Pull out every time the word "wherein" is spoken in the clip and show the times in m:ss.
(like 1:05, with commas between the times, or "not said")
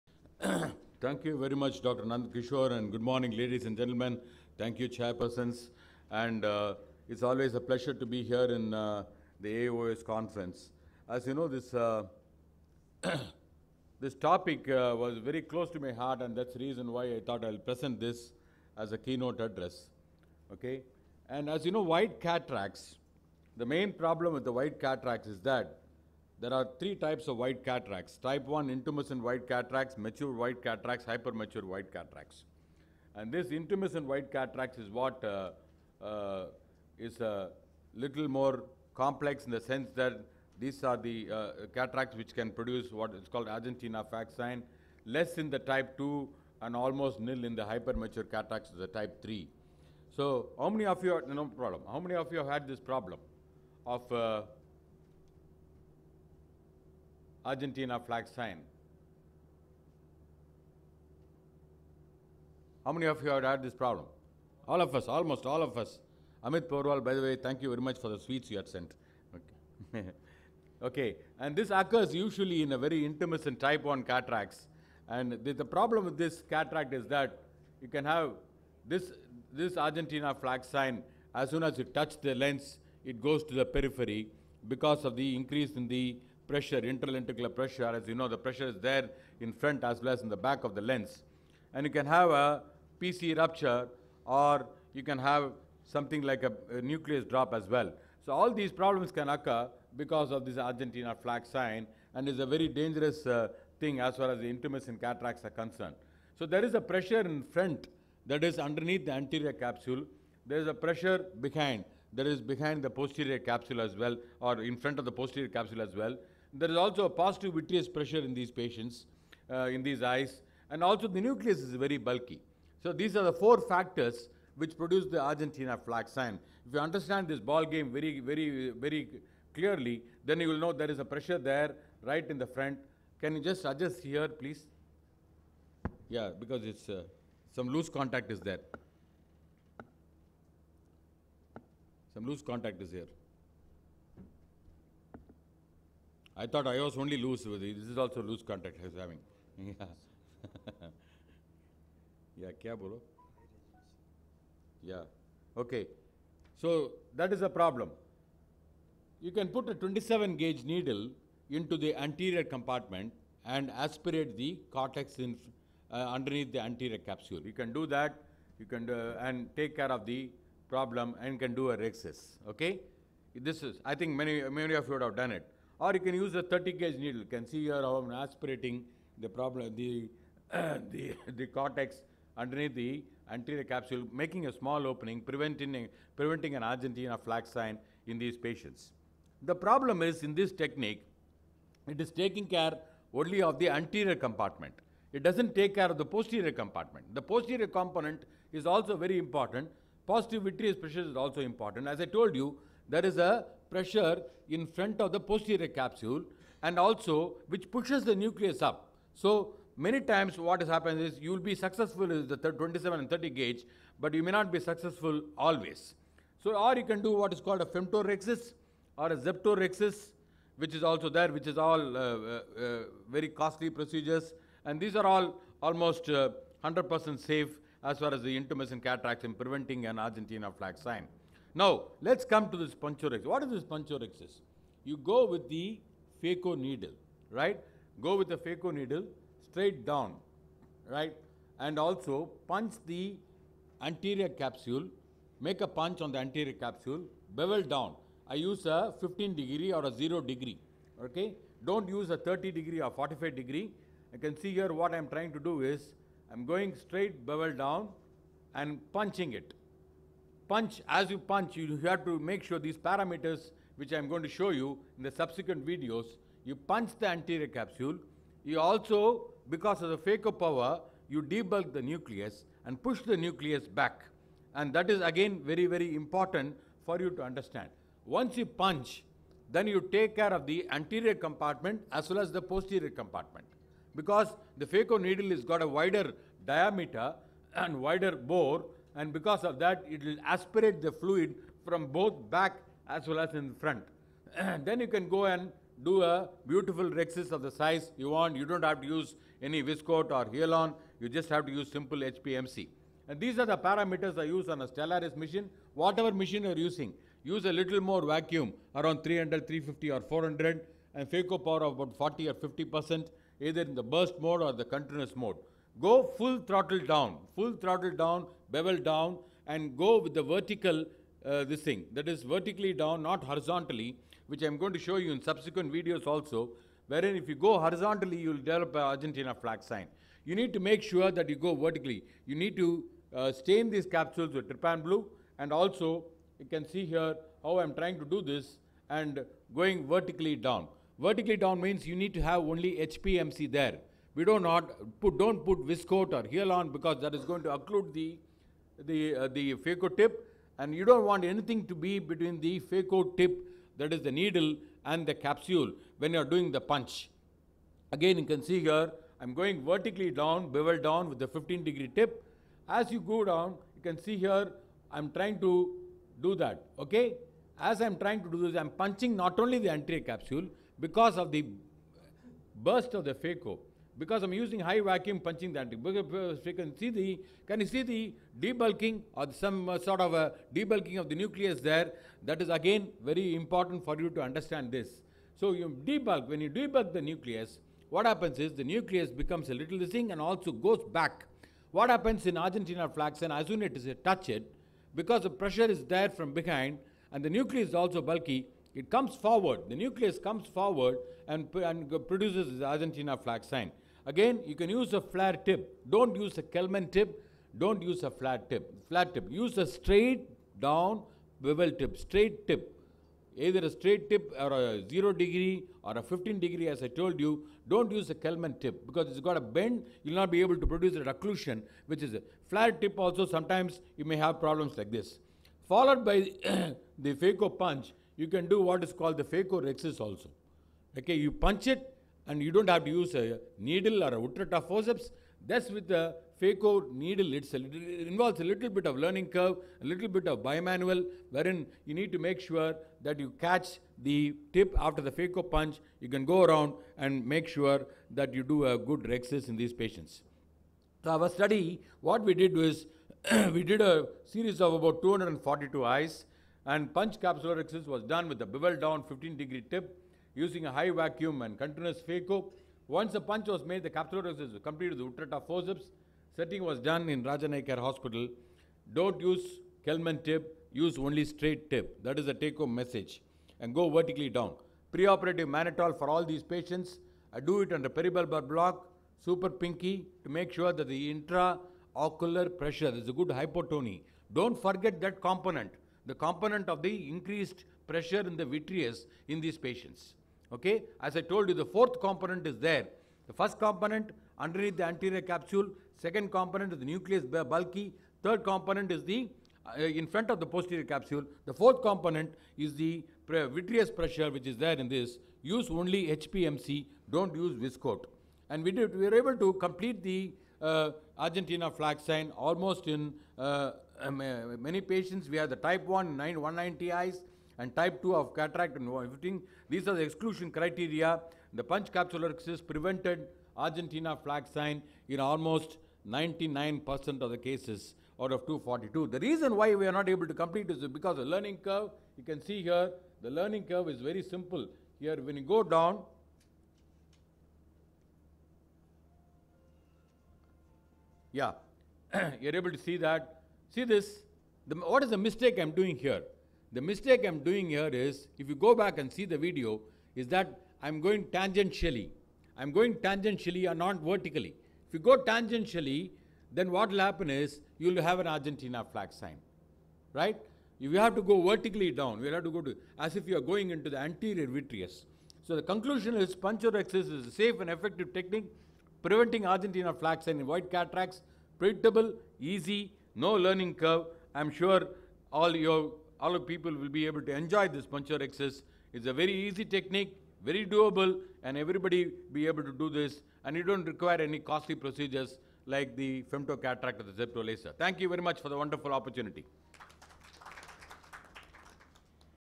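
5:26, 7:21.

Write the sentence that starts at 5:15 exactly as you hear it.
Go full throttle down, full throttle down, bevel down, and go with the vertical, uh, this thing.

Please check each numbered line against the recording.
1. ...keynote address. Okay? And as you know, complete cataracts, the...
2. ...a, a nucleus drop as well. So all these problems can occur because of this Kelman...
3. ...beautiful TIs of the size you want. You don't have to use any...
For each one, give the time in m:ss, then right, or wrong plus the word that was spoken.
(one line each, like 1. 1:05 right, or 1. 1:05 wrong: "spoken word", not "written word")
1. 0:18 wrong: "white", not "complete"
2. 1:36 wrong: "Argentina", not "Kelman"
3. 4:56 wrong: "Rexis", not "TIs".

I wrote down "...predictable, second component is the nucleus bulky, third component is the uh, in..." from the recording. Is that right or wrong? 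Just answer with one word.
wrong.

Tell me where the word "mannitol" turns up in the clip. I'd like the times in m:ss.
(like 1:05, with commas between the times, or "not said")
7:55.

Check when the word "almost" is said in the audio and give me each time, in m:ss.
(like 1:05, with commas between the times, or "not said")
0:46, 1:05, 3:45, 8:32, 8:45.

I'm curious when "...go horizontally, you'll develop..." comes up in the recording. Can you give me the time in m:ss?
5:27.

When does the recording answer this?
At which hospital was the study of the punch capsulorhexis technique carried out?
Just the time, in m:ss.
7:47.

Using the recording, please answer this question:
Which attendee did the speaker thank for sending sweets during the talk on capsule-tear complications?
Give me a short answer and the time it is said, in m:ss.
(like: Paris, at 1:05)
Amit Porwal, at 1:06.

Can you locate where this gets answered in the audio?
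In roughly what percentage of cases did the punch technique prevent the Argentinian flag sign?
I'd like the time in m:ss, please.
8:46.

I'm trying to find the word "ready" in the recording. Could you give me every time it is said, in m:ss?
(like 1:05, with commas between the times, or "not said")
not said.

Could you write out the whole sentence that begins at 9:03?
See this, the, what is the mistake I'm doing here?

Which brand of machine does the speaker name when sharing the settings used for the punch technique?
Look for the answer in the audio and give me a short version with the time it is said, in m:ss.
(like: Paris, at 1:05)
Stellaris, at 5:04.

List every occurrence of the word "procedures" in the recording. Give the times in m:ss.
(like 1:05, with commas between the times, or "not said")
3:43, 9:44.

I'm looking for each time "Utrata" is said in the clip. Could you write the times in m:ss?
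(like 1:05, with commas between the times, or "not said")
7:14, 7:45.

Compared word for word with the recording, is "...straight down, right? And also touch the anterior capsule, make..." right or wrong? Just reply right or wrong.
wrong.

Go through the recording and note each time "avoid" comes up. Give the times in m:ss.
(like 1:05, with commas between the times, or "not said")
9:30.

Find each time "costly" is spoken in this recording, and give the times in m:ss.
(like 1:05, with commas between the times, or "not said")
3:43, 9:44.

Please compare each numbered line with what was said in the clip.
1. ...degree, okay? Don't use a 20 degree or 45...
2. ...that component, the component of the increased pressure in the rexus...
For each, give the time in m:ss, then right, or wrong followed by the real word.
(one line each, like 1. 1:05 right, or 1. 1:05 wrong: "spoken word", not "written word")
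1. 4:10 wrong: "30", not "20"
2. 8:05 wrong: "vitreous", not "rexus".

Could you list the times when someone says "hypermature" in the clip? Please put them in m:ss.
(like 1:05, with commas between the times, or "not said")
0:31, 0:47.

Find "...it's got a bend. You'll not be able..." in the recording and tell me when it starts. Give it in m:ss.
6:59.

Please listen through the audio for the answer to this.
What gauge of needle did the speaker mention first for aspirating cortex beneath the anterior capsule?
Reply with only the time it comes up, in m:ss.
2:39.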